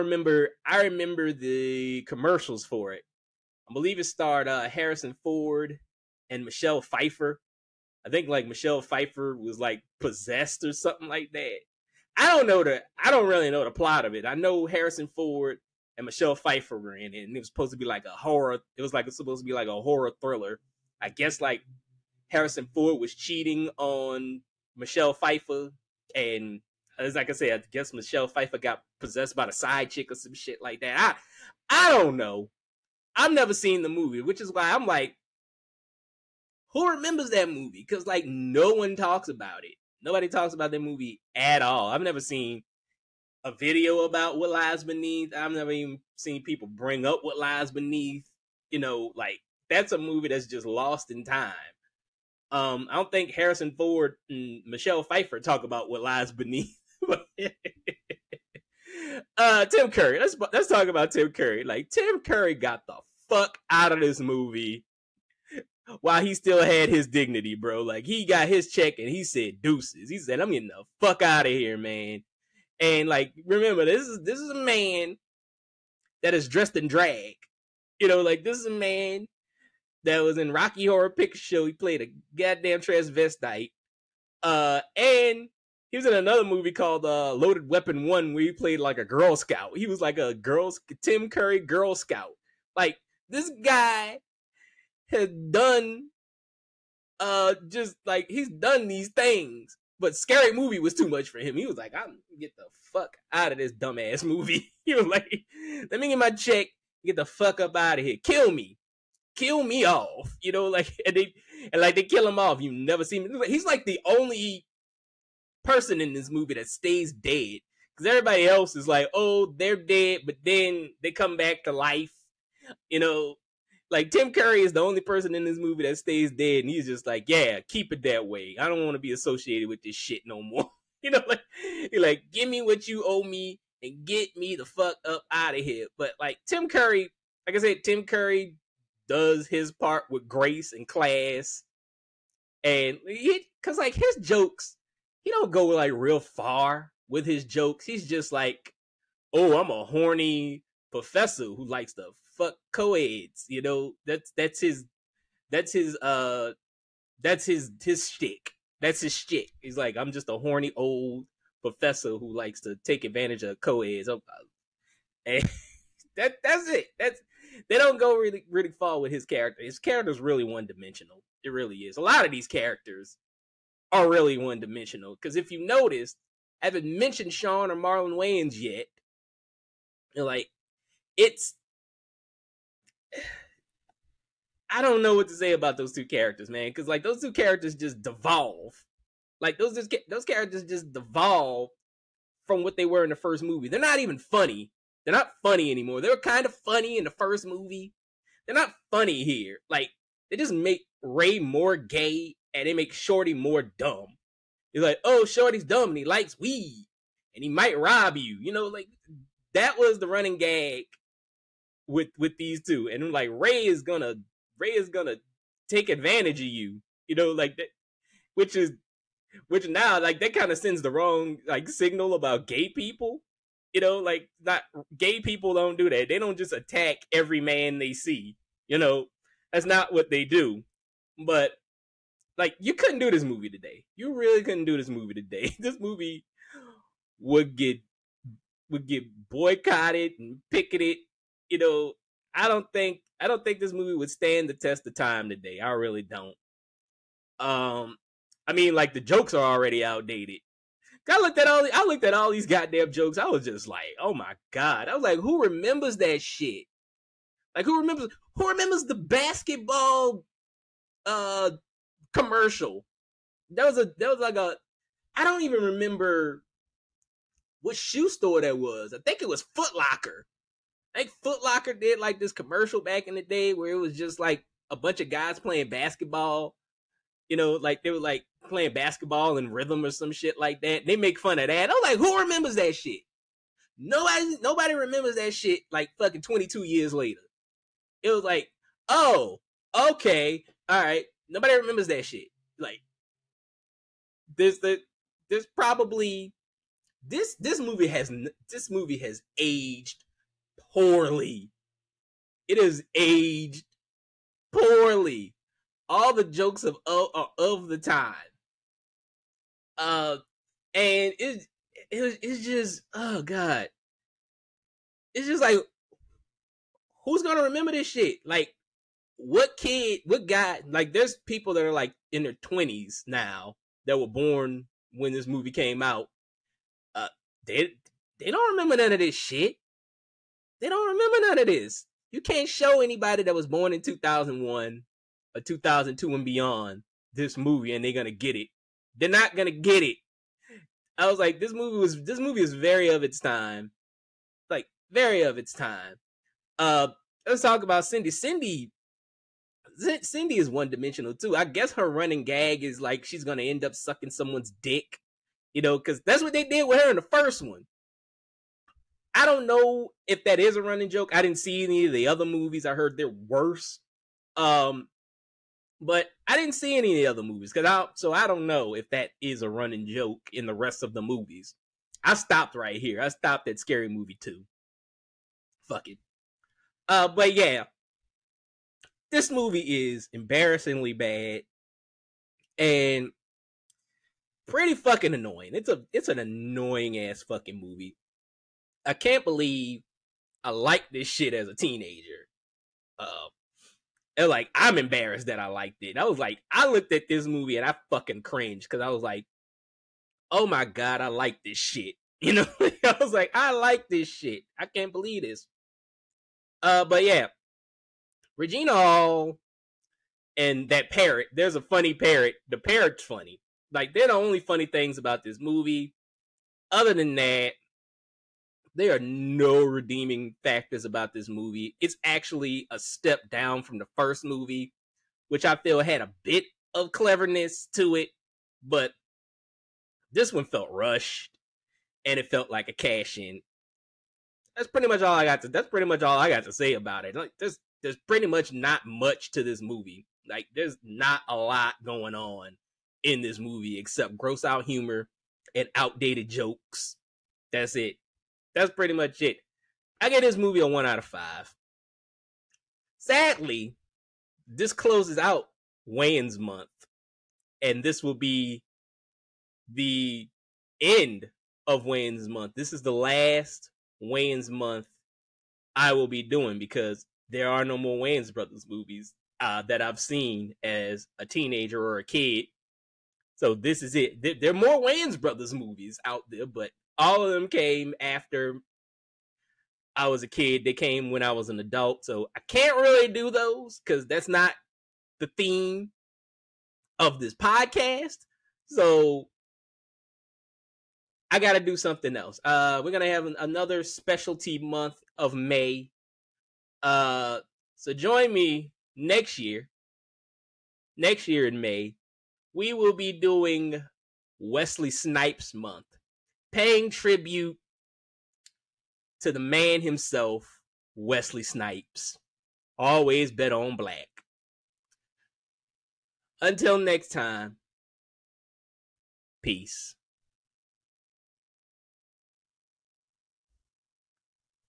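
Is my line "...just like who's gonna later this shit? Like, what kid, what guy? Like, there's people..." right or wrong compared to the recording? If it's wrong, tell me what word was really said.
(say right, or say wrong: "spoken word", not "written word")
wrong: "remember", not "later".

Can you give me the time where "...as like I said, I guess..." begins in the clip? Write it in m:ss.
0:26.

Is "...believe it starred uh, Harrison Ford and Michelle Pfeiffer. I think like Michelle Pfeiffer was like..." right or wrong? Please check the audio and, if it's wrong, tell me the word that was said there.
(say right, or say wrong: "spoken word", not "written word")
right.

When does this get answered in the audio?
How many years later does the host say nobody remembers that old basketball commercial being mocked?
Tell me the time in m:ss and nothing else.
4:46.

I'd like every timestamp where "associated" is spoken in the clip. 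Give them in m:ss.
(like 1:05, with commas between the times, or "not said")
2:09.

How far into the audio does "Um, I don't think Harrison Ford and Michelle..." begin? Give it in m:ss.
0:52.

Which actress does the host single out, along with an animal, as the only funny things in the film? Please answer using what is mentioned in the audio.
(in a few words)
Regina Hall.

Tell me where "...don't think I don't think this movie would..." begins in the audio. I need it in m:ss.
4:02.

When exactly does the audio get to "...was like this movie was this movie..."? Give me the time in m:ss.
5:41.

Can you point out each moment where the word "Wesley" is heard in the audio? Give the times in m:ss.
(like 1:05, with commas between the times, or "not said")
8:24, 8:30.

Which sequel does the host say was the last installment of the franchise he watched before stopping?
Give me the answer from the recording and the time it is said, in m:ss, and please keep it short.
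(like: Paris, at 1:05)
Scary Movie Two, at 6:13.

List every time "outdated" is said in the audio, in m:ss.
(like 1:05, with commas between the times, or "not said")
4:09, 7:25.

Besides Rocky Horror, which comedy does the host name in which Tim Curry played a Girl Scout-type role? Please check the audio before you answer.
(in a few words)
Loaded Weapon One.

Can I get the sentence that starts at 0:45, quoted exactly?
I've never even seen people bring up what lies beneath.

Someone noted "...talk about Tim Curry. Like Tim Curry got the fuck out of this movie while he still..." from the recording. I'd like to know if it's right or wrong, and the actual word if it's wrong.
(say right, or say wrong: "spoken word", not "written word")
right.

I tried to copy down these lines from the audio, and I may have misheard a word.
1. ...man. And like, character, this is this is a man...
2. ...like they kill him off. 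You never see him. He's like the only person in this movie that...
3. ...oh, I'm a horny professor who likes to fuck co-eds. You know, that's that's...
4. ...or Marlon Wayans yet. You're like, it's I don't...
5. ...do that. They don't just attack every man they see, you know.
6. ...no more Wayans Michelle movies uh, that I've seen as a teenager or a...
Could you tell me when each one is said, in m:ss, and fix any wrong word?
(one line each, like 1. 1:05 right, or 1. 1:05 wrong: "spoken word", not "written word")
1. 1:11 wrong: "remember", not "character"
2. 1:51 right
3. 2:29 right
4. 2:57 right
5. 3:45 right
6. 7:47 wrong: "Brothers", not "Michelle".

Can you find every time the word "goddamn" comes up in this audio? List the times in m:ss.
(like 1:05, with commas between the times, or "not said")
1:22, 4:12.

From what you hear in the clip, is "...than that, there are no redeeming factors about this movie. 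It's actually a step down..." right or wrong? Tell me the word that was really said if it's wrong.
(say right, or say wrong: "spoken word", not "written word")
right.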